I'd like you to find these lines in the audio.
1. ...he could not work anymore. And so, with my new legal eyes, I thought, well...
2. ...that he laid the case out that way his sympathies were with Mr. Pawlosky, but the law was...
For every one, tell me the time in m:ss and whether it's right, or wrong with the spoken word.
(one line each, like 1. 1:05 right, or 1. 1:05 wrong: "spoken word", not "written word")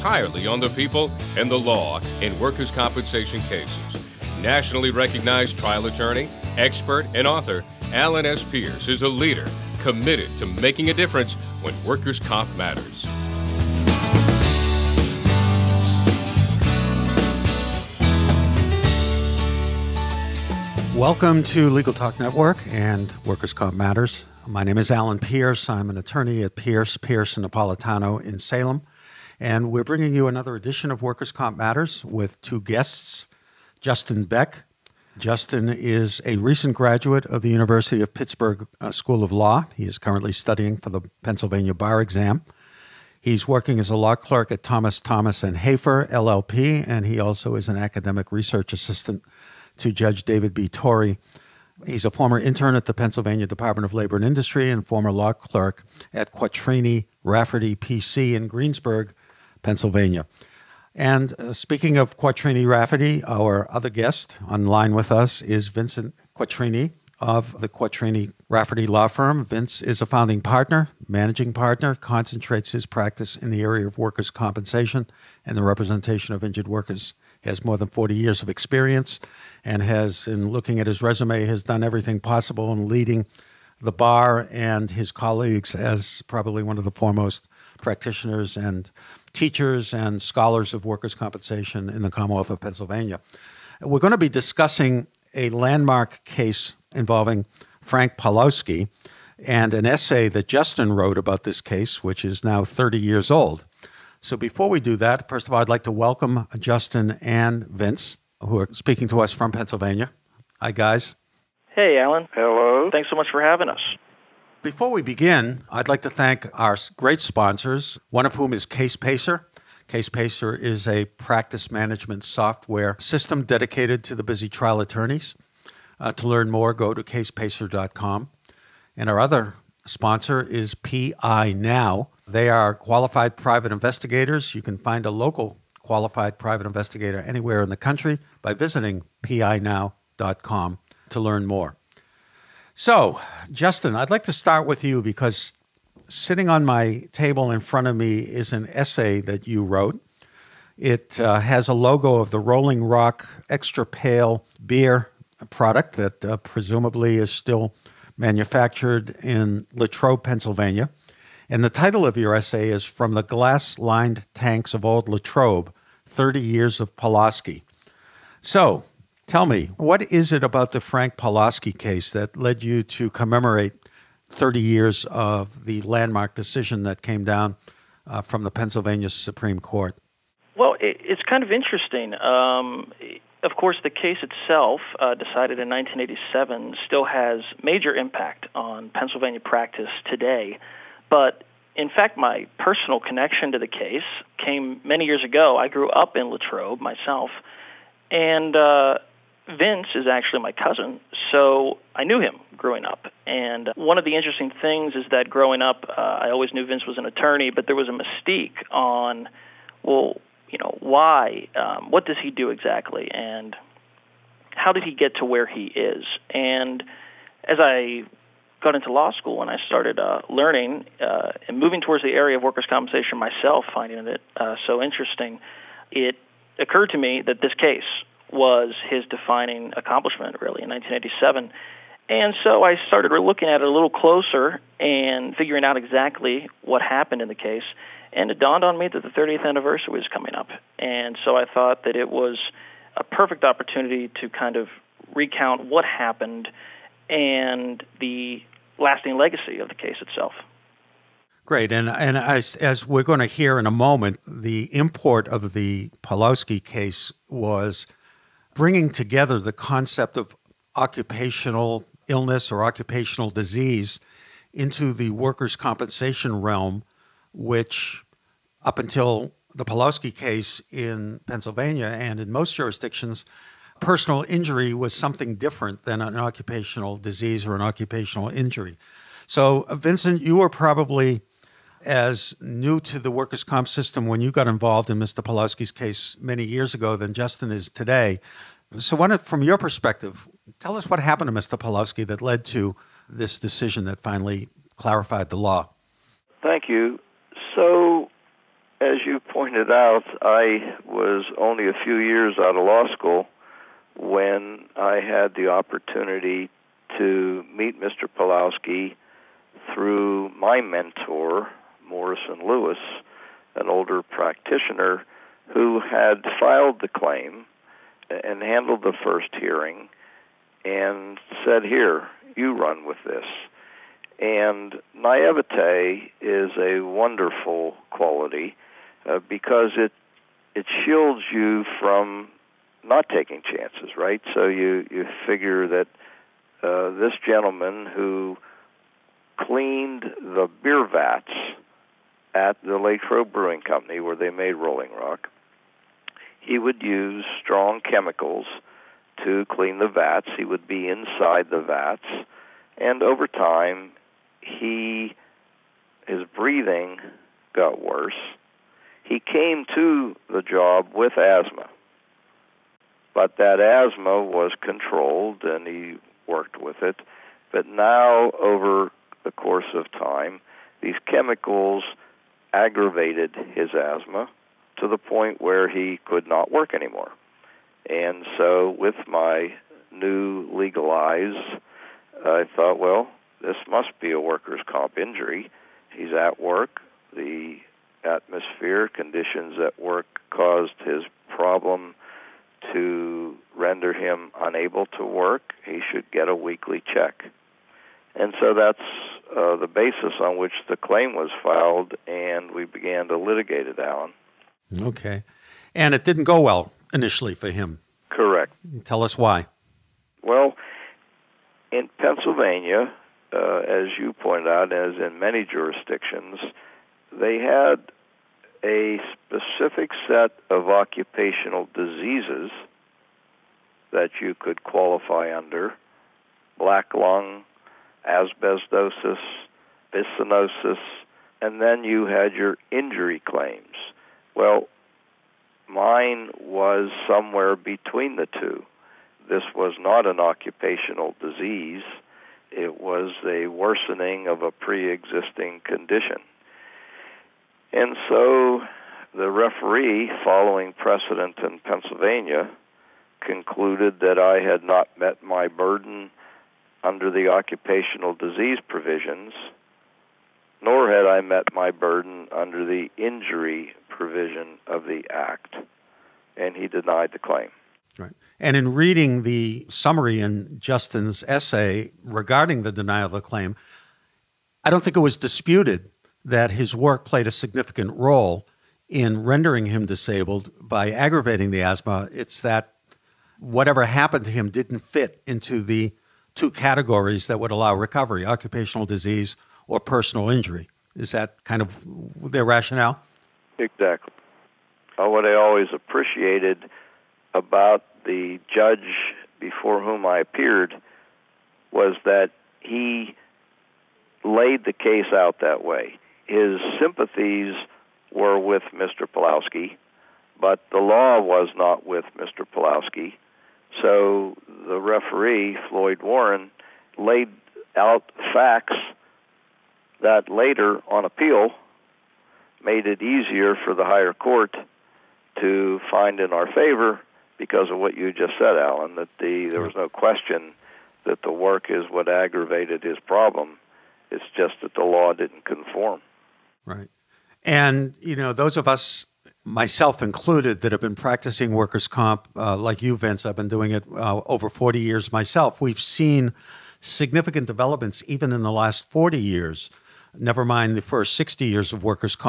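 1. 6:15 right
2. 8:22 right.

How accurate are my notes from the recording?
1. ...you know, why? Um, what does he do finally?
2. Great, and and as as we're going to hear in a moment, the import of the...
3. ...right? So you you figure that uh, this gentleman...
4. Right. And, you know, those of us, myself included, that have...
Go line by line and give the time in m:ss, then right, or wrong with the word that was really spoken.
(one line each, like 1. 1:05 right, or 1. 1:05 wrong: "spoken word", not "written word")
1. 3:30 wrong: "exactly", not "finally"
2. 4:11 right
3. 5:33 right
4. 8:56 right.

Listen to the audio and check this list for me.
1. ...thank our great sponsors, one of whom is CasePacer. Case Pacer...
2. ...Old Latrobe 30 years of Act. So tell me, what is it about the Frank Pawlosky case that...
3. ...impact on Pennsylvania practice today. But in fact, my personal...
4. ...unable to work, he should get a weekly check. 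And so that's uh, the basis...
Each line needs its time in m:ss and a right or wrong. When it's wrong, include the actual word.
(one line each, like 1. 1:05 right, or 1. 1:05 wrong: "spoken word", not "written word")
1. 1:56 right
2. 2:44 wrong: "Pawlosky", not "Act"
3. 3:07 right
4. 6:34 right.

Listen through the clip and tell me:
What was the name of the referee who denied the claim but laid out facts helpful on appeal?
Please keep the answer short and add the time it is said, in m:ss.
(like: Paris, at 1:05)
Floyd Warren, at 8:35.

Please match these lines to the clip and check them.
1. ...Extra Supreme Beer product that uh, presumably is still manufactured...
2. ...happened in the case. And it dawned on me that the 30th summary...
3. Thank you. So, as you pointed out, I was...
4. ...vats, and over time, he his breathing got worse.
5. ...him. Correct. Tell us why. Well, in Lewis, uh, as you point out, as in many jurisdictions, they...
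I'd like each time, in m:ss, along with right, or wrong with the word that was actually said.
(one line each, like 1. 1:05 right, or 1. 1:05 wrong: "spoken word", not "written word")
1. 2:33 wrong: "Pale", not "Supreme"
2. 3:56 wrong: "anniversary", not "summary"
3. 4:56 right
4. 5:51 right
5. 6:47 wrong: "Pennsylvania", not "Lewis".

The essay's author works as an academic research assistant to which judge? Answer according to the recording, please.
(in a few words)
David B. Torrey.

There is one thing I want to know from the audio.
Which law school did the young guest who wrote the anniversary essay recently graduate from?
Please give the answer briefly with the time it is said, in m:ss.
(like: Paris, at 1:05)
University of Pittsburgh, at 0:37.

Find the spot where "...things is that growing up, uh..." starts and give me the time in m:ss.
3:24.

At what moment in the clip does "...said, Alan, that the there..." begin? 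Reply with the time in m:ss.
8:48.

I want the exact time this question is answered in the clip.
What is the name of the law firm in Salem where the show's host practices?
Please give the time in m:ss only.
0:26.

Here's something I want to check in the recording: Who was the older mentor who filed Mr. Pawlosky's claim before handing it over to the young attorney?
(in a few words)
Morrison Lewis.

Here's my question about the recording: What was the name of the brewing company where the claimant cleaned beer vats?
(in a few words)
Lakeshore Brewing Company.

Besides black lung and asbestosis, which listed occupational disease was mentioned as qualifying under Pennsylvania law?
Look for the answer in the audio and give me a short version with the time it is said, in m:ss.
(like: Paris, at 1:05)
byssinosis, at 7:09.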